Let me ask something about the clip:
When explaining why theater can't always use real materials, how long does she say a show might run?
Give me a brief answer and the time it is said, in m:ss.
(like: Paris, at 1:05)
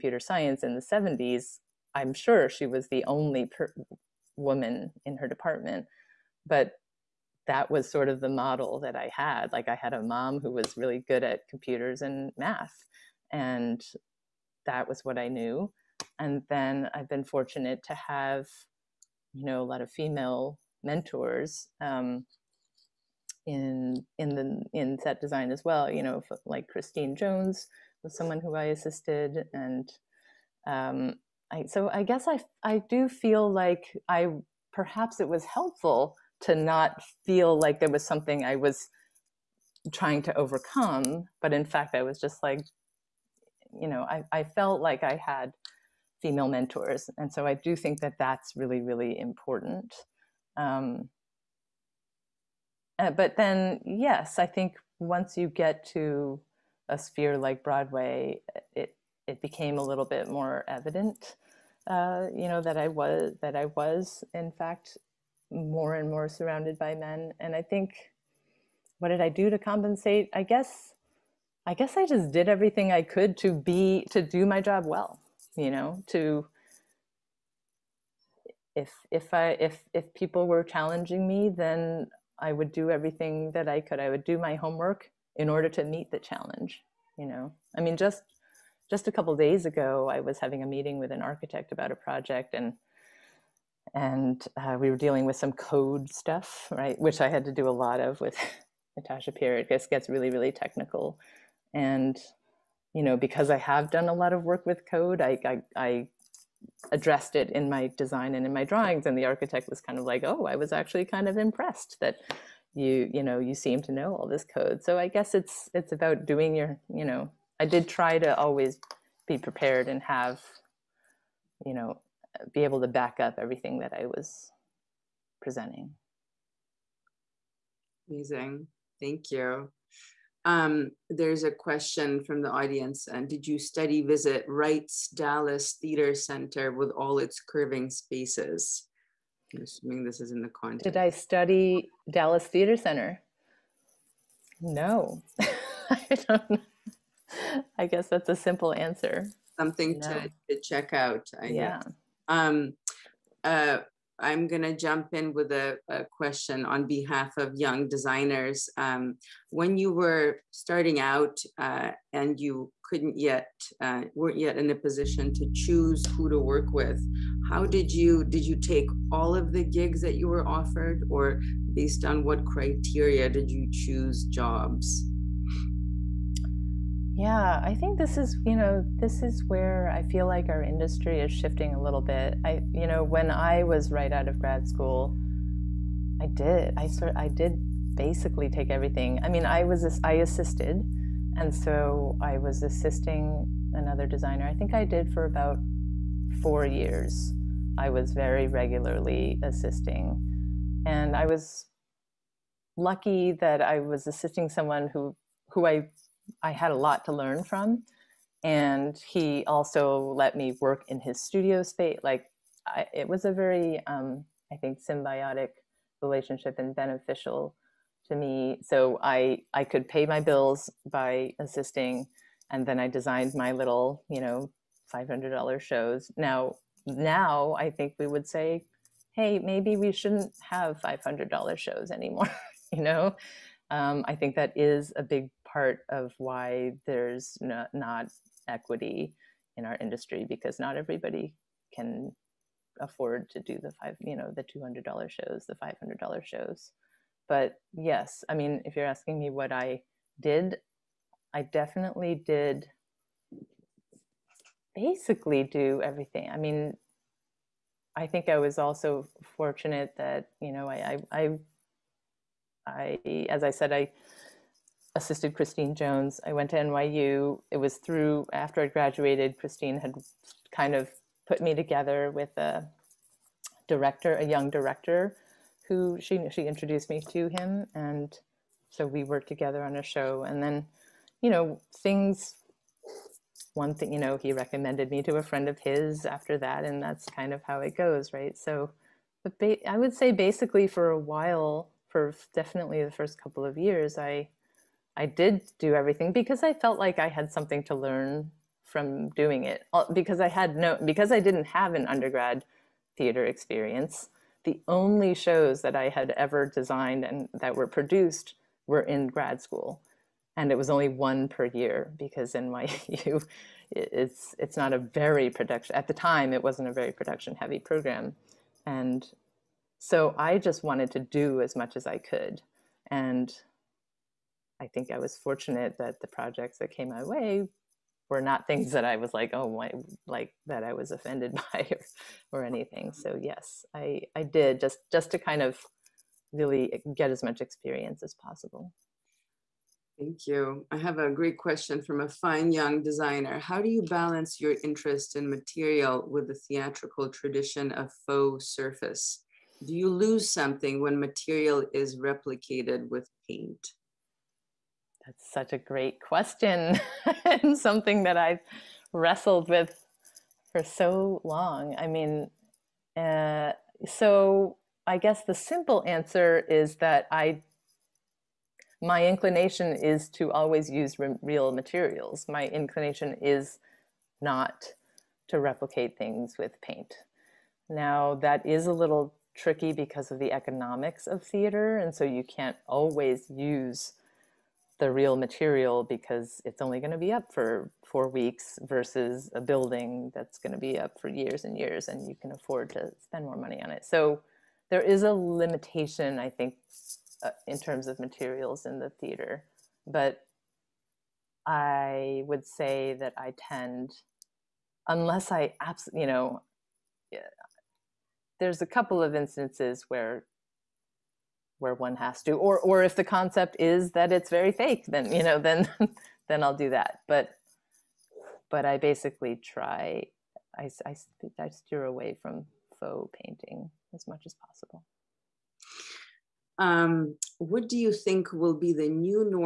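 4 weeks, at 6:27.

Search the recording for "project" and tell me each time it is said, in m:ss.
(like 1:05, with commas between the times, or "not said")
1:31, 5:26.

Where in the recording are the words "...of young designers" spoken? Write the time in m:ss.
2:37.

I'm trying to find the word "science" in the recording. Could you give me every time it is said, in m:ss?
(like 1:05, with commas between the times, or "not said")
0:00.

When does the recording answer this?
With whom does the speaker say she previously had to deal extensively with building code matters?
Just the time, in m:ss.
1:38.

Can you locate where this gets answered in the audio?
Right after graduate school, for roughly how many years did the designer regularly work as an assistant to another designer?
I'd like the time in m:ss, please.
3:16.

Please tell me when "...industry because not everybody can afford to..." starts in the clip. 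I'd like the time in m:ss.
3:59.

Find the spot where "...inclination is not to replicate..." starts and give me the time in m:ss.
6:12.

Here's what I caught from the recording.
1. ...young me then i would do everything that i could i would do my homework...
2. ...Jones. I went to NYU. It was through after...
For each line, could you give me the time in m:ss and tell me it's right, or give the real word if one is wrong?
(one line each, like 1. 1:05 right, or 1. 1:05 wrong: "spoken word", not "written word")
1. 1:20 wrong: "challenging", not "young"
2. 4:25 right.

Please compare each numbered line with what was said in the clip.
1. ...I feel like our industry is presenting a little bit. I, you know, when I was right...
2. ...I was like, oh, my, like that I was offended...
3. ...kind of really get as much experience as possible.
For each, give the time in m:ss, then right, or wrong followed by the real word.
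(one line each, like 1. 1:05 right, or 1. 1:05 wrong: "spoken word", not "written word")
1. 2:59 wrong: "shifting", not "presenting"
2. 5:28 right
3. 5:35 right.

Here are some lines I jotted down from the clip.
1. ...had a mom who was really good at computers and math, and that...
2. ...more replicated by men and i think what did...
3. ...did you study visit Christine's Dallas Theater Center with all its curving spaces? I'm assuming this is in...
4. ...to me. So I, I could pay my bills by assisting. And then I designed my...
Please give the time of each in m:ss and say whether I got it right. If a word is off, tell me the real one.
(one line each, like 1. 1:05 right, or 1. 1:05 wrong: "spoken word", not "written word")
1. 0:09 right
2. 1:06 wrong: "surrounded", not "replicated"
3. 2:13 wrong: "Wright", not "Christine"
4. 3:38 right.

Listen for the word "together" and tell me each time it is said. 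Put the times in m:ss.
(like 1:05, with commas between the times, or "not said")
4:31, 4:39.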